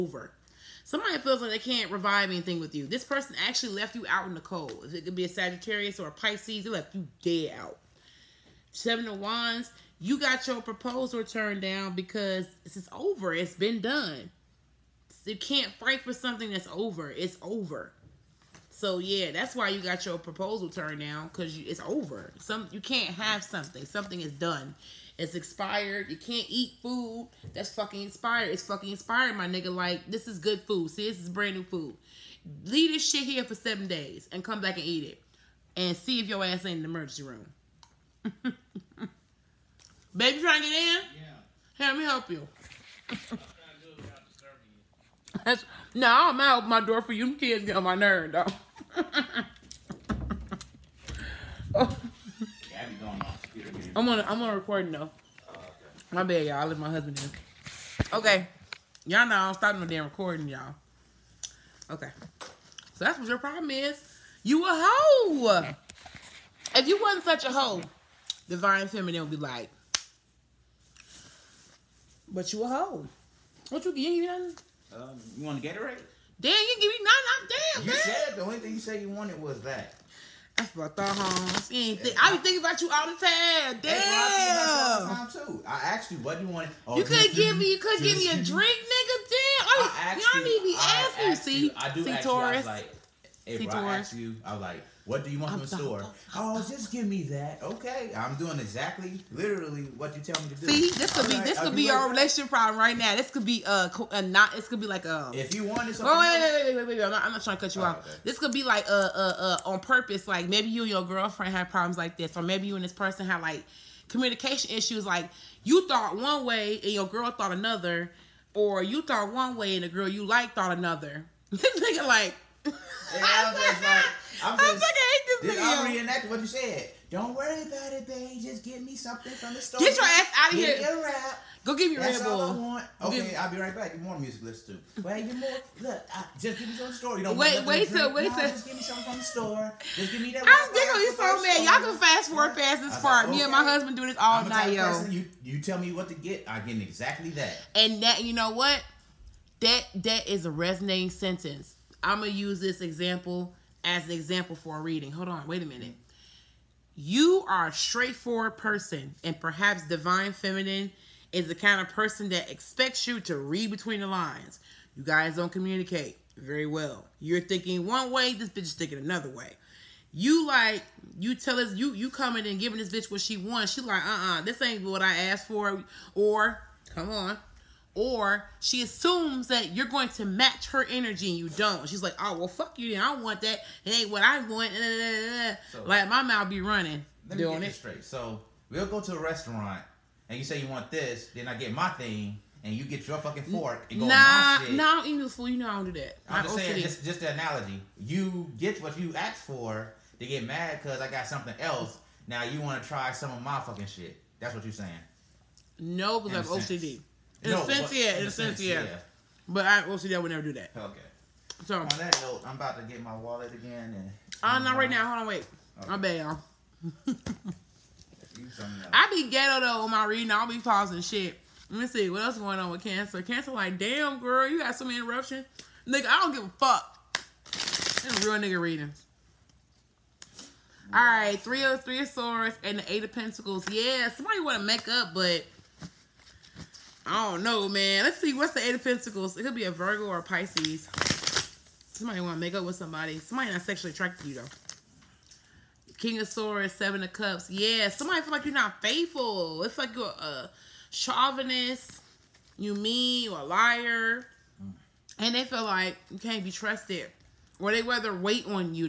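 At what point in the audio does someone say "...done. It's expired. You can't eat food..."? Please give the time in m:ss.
0:24.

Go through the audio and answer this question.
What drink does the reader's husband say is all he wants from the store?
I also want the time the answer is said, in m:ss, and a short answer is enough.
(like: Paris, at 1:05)
Red Bull, at 2:12.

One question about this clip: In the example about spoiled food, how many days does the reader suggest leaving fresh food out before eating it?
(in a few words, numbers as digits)
7.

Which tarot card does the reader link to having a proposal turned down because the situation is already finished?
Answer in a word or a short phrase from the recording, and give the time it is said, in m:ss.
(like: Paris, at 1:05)
Seven of Wands, at 0:08.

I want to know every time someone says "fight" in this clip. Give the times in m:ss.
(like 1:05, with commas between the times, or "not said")
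0:15.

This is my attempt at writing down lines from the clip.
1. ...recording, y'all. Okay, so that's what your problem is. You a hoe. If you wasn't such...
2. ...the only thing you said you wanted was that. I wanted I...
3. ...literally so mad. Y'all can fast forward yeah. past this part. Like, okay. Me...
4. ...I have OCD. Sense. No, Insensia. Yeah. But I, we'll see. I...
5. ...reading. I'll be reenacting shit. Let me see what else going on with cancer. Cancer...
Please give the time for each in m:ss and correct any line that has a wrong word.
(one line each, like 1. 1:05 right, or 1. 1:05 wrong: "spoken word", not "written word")
1. 1:00 right
2. 1:18 wrong: "fucked", not "wanted"
3. 2:20 right
4. 3:26 right
5. 3:40 wrong: "pausing", not "reenacting".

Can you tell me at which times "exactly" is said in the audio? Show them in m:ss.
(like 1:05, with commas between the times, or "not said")
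1:38, 2:26.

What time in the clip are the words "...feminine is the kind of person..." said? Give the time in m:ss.
2:40.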